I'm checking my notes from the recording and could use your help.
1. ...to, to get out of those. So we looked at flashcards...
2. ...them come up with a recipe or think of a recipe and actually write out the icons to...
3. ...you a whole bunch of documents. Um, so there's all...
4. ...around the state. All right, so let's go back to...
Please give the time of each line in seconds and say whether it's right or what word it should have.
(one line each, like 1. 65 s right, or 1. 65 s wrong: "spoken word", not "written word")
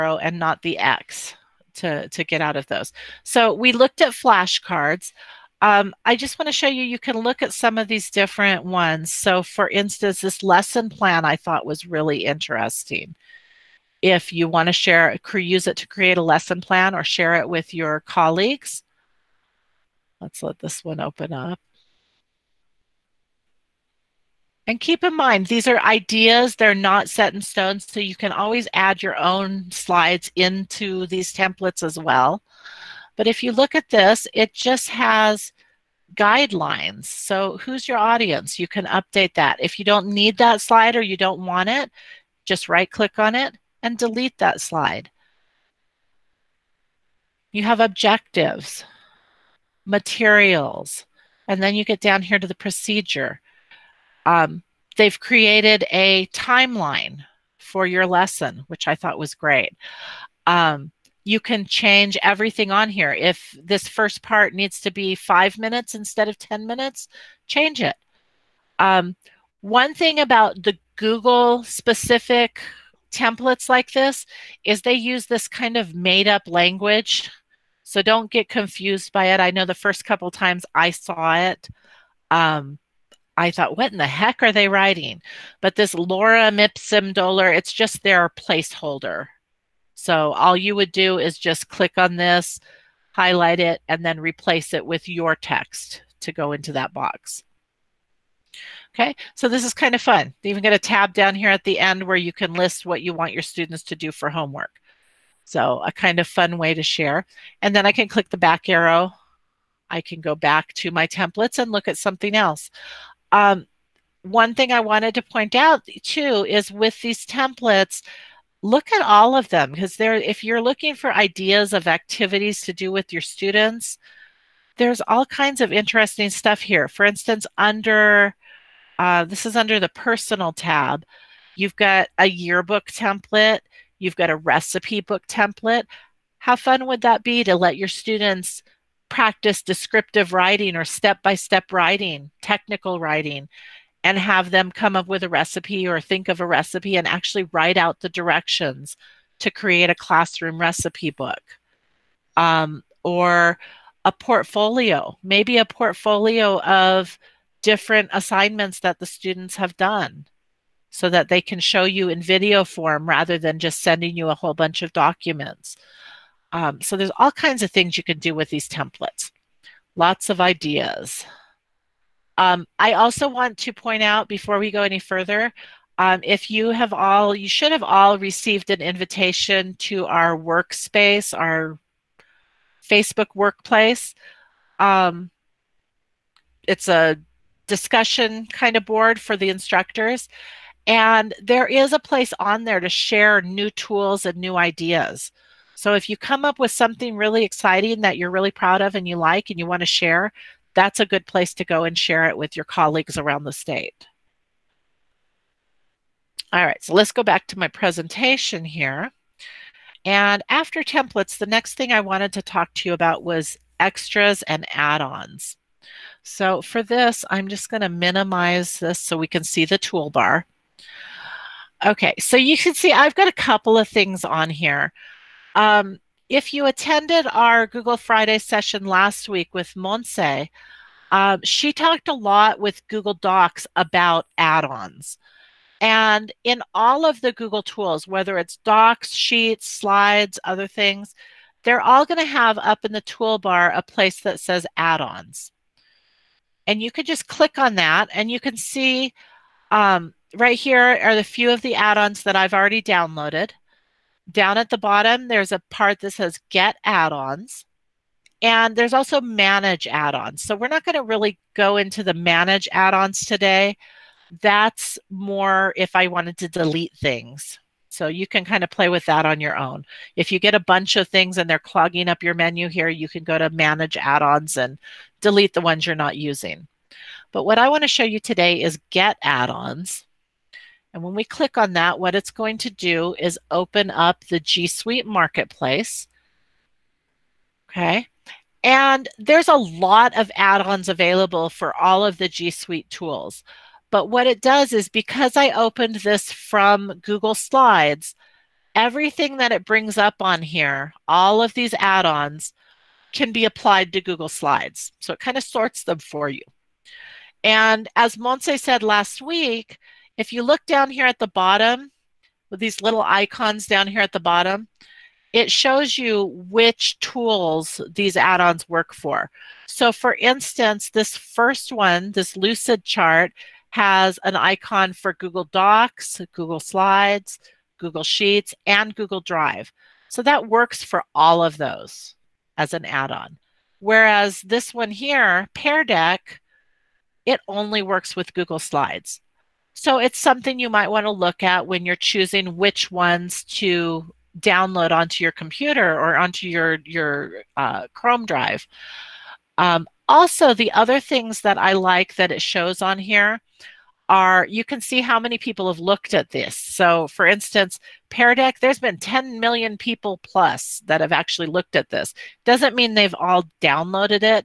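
1. 1 s right
2. 144 s wrong: "directions", not "icons"
3. 164 s right
4. 203 s right.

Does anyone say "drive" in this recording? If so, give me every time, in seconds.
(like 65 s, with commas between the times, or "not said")
329 s, 348 s.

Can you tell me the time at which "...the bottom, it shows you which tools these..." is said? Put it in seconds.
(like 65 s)
314 s.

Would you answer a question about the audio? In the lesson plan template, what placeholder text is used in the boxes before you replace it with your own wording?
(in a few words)
Lorem ipsum dolor.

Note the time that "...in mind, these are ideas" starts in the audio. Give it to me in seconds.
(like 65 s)
25 s.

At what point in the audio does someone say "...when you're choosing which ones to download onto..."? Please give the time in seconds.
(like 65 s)
341 s.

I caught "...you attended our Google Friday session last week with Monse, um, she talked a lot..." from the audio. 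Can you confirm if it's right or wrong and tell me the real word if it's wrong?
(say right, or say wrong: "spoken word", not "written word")
right.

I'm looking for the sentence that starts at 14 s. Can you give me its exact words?
If you want to share, use it to create a lesson plan or share it with your colleagues.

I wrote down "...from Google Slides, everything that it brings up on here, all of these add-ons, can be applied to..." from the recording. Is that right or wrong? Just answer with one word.
right.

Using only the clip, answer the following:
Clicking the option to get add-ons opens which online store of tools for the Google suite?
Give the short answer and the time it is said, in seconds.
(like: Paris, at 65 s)
G Suite Marketplace, at 284 s.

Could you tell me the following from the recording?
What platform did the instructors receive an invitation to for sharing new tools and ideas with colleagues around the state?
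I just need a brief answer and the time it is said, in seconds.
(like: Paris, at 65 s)
Facebook Workplace, at 182 s.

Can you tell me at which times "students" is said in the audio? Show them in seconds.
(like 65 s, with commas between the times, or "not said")
103 s, 123 s, 137 s, 159 s.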